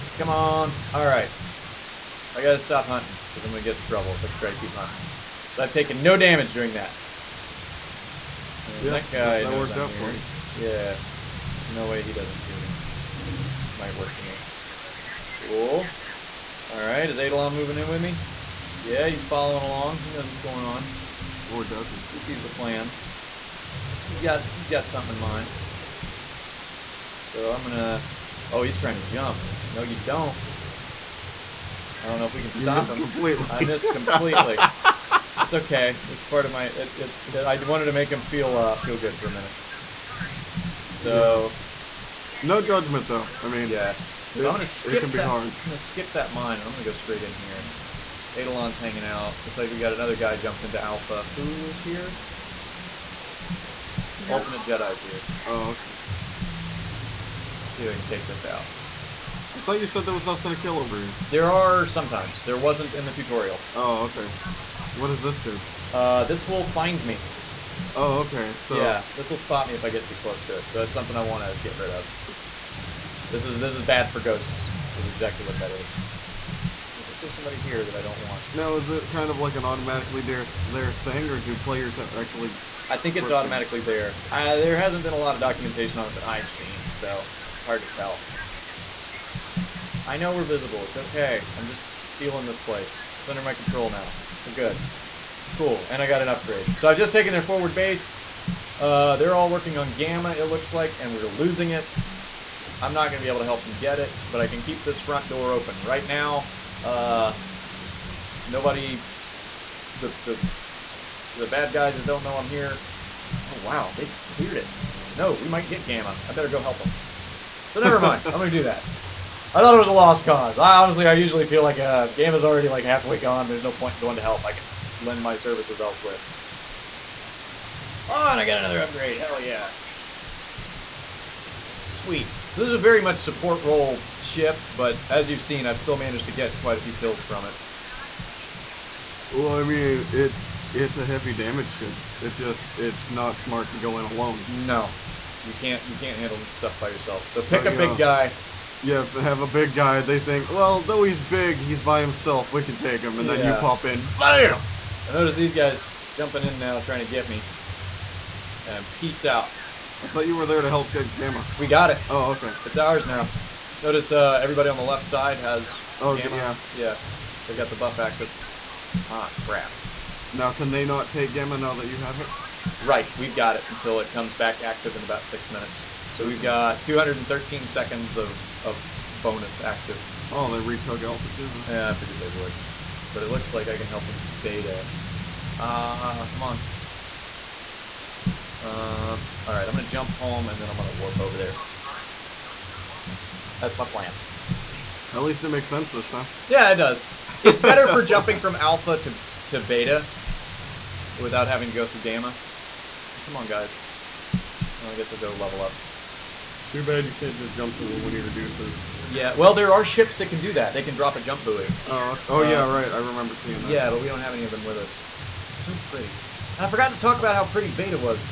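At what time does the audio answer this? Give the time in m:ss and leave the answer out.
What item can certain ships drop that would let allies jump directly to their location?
3:31.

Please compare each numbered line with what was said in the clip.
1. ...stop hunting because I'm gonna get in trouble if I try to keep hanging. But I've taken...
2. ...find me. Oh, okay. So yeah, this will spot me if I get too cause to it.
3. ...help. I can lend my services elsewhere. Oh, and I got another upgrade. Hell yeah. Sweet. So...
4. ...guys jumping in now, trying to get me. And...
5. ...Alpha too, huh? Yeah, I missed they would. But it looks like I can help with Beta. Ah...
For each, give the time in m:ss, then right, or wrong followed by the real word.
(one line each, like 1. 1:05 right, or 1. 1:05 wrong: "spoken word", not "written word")
1. 0:02 wrong: "hunting", not "hanging"
2. 1:06 wrong: "close", not "cause"
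3. 2:04 right
4. 2:35 right
5. 3:01 wrong: "figured", not "missed".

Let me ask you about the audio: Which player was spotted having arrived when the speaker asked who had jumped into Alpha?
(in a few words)
Ultimate Jedi.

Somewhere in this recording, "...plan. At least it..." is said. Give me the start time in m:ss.
3:13.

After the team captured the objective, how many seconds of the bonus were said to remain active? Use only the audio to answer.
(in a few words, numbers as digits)
213.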